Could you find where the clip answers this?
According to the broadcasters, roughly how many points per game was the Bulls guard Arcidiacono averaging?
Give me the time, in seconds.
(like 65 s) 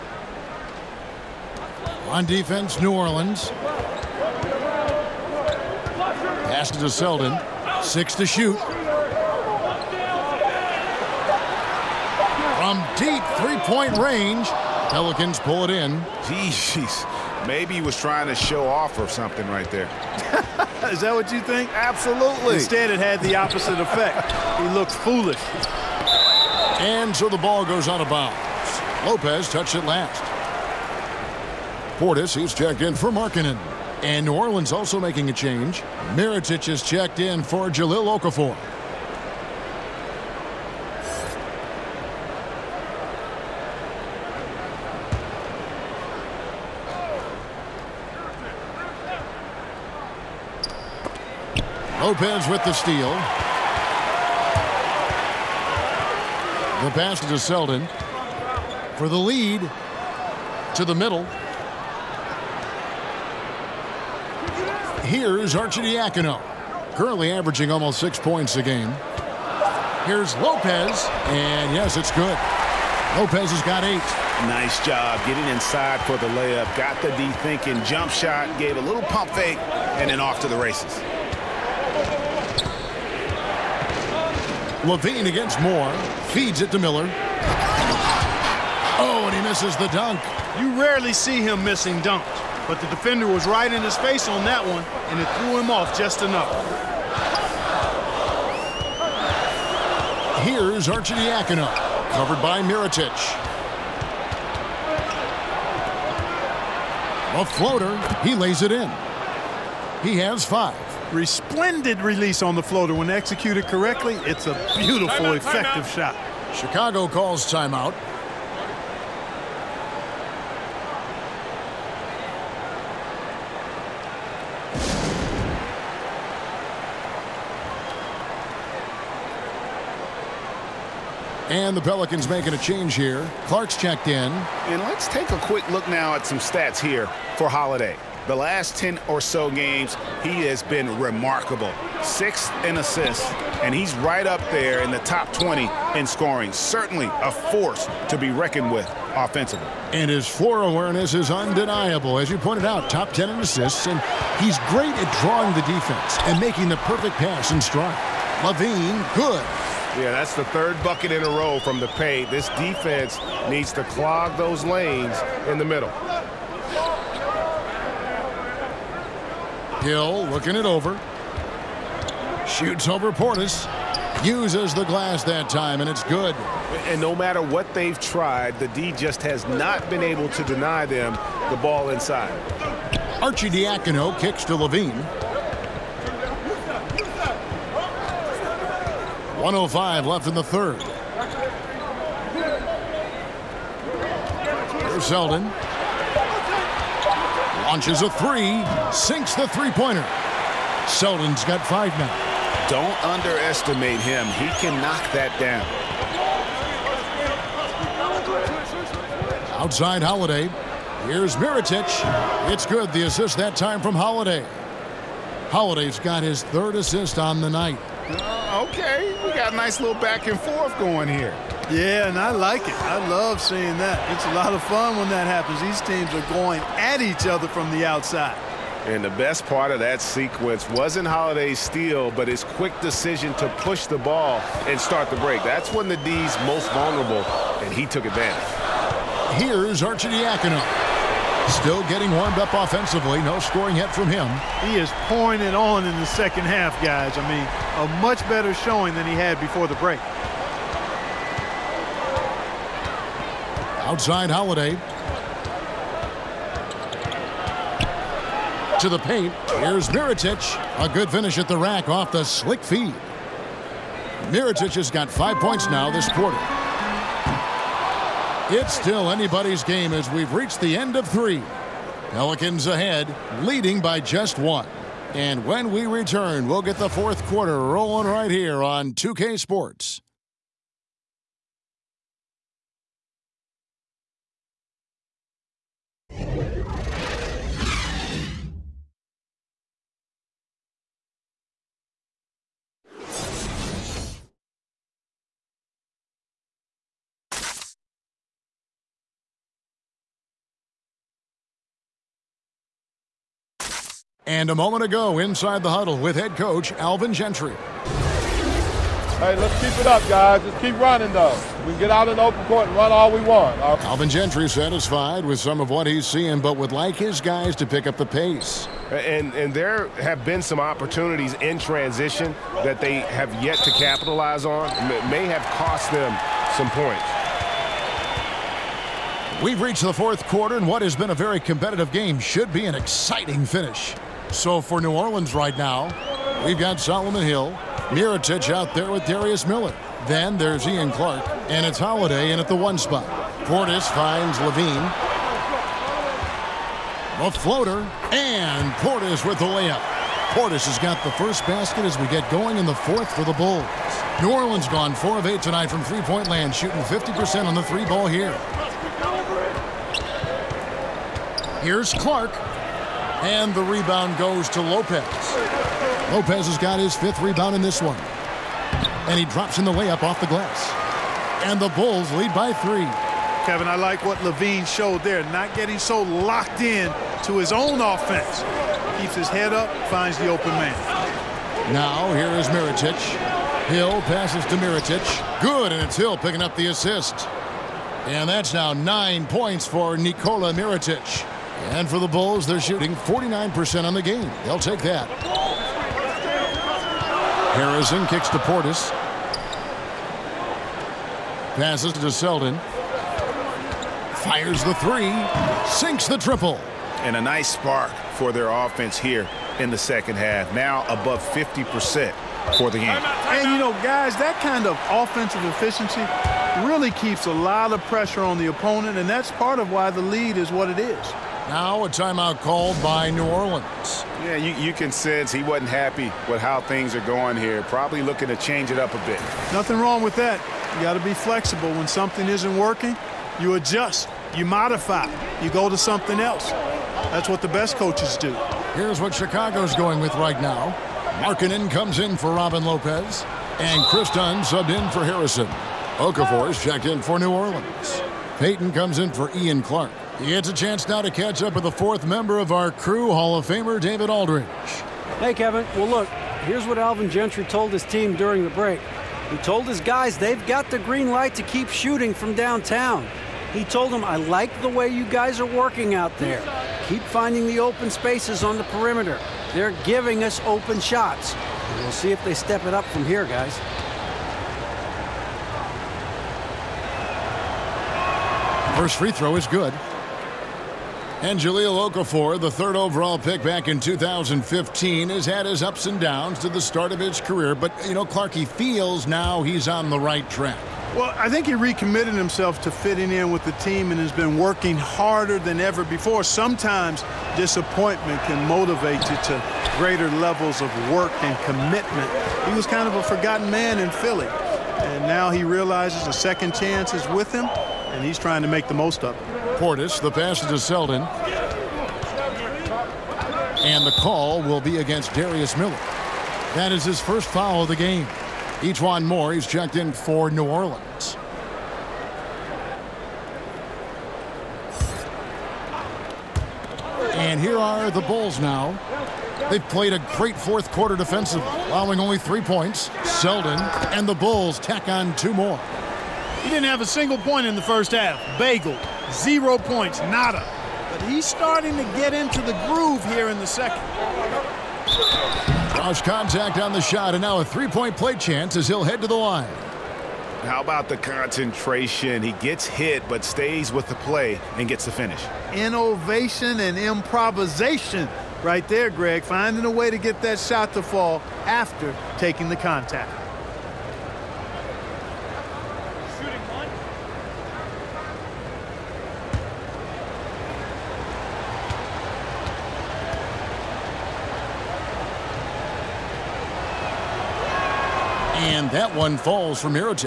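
67 s.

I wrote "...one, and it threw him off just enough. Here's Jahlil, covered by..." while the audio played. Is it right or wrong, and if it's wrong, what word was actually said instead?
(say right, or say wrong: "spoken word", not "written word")
wrong: "Arcidiacono", not "Jahlil".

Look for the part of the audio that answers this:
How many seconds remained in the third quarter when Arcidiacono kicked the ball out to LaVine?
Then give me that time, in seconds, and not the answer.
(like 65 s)
189 s.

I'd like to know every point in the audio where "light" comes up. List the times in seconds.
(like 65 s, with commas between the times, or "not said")
461 s.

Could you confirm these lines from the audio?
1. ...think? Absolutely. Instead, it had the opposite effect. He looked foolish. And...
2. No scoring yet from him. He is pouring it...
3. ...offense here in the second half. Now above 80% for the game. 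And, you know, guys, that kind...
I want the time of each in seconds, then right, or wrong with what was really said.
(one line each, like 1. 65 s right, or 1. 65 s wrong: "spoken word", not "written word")
1. 21 s right
2. 243 s right
3. 408 s wrong: "50", not "80".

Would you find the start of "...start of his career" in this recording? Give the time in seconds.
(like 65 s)
486 s.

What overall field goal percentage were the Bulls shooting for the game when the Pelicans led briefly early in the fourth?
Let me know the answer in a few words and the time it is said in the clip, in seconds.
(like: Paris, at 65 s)
49%, at 392 s.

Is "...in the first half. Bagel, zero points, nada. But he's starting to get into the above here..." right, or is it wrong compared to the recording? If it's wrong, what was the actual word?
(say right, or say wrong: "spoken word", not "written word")
wrong: "groove", not "above".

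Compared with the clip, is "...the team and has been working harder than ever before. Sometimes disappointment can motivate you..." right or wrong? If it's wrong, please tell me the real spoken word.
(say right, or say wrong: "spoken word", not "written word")
right.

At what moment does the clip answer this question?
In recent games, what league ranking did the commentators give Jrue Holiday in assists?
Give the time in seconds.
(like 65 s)
142 s.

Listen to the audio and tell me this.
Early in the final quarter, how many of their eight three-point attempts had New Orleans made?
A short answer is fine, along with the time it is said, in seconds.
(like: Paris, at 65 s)
4, at 354 s.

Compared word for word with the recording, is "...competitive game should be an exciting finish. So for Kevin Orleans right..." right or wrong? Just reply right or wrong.
wrong.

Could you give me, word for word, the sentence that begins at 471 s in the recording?
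And we'll see if they step it up from here, guys.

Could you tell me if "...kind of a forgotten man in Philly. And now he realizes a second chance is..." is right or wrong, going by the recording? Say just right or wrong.
right.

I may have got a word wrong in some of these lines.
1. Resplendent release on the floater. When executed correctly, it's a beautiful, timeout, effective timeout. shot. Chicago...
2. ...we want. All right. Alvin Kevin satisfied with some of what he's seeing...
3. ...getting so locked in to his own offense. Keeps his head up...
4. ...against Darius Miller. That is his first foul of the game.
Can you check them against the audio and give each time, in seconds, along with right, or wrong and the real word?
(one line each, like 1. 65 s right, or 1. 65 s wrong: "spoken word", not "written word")
1. 111 s right
2. 313 s wrong: "Gentry", not "Kevin"
3. 375 s right
4. 514 s right.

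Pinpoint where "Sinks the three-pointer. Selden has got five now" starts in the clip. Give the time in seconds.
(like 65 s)
198 s.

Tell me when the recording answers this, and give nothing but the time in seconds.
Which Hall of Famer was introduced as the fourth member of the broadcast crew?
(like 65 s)
453 s.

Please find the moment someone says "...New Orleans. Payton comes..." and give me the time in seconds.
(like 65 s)
447 s.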